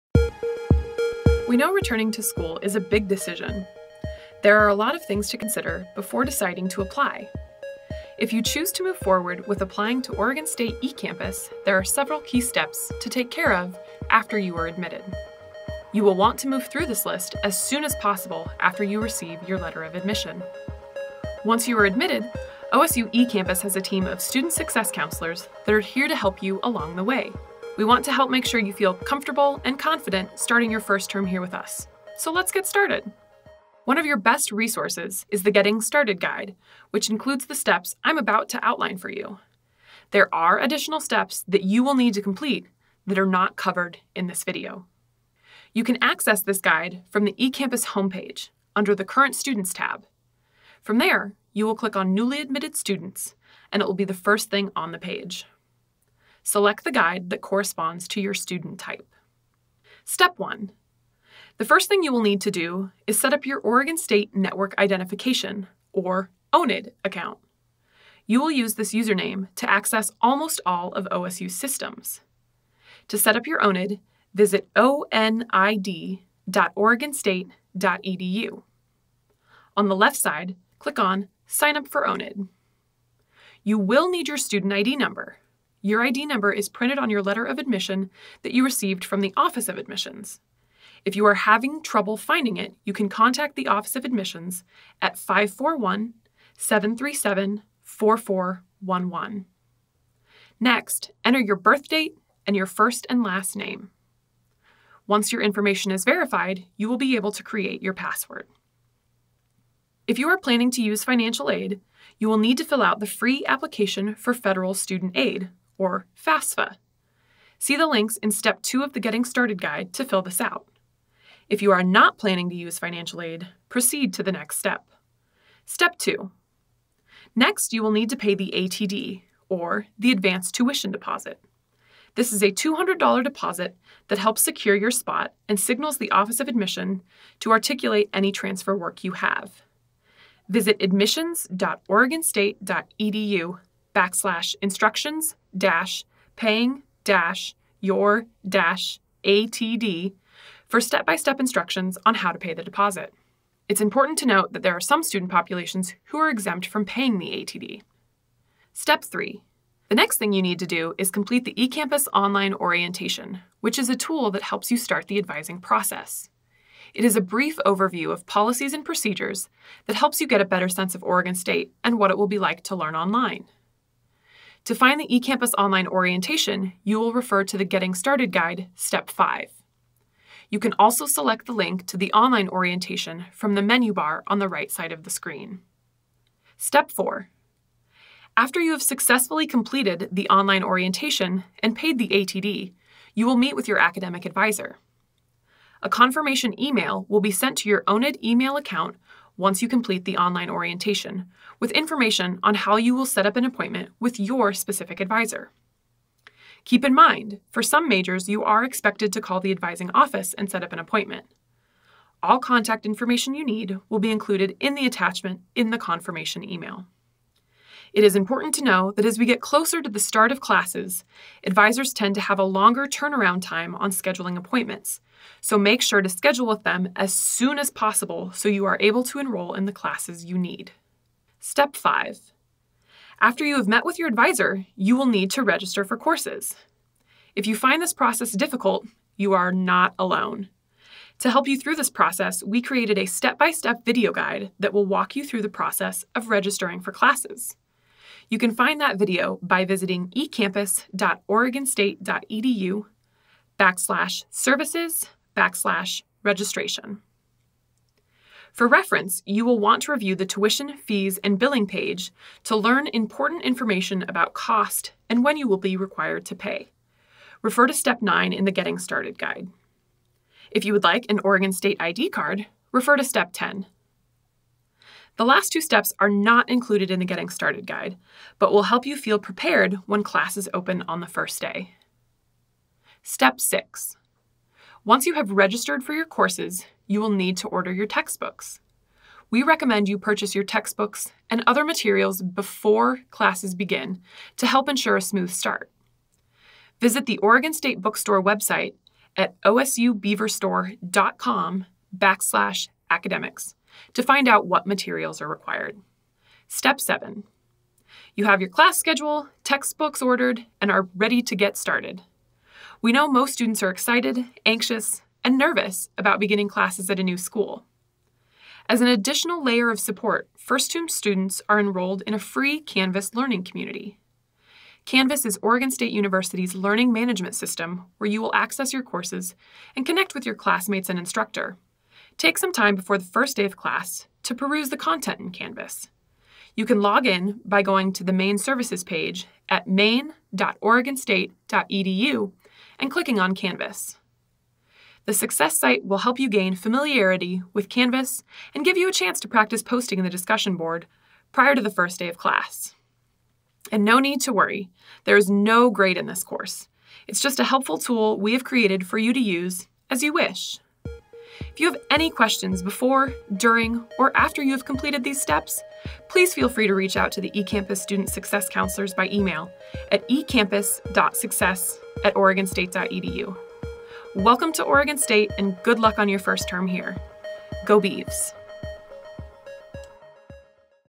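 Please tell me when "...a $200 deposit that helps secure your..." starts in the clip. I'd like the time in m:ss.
2:12.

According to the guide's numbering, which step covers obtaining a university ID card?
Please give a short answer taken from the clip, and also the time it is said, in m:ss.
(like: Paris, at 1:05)
Step 10, at 4:33.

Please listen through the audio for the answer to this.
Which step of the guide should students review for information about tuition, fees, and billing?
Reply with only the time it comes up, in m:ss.
4:27.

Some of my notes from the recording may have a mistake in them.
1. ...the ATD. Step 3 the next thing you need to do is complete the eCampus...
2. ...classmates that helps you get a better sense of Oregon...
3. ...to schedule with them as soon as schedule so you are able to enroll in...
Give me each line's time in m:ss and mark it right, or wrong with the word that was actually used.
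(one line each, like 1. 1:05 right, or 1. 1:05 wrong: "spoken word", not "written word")
1. 2:37 right
2. 2:48 wrong: "procedures", not "classmates"
3. 3:46 wrong: "possible", not "schedule".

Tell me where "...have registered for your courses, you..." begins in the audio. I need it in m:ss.
4:45.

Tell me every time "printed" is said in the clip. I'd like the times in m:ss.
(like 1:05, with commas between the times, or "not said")
1:26.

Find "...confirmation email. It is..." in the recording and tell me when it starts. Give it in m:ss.
3:35.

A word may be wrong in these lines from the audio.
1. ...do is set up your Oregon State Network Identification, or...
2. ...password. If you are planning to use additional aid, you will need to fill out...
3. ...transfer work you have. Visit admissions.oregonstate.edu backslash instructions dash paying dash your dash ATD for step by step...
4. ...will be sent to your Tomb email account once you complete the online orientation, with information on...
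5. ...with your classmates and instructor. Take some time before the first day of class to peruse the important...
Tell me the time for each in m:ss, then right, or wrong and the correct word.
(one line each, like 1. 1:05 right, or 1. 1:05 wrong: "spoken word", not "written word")
1. 1:02 right
2. 1:47 wrong: "financial", not "additional"
3. 2:18 right
4. 3:17 wrong: "ONID", not "Tomb"
5. 5:30 wrong: "content", not "important".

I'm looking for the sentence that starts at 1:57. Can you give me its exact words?
See the links in Step 2 of the Getting Started Guide to fill this out.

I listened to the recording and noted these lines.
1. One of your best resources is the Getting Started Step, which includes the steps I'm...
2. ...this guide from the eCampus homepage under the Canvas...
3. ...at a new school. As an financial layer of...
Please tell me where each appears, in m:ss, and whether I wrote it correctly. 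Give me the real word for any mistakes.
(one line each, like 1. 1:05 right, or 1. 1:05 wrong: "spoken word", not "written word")
1. 0:33 wrong: "Guide", not "Step"
2. 0:46 wrong: "Current", not "Canvas"
3. 5:16 wrong: "additional", not "financial".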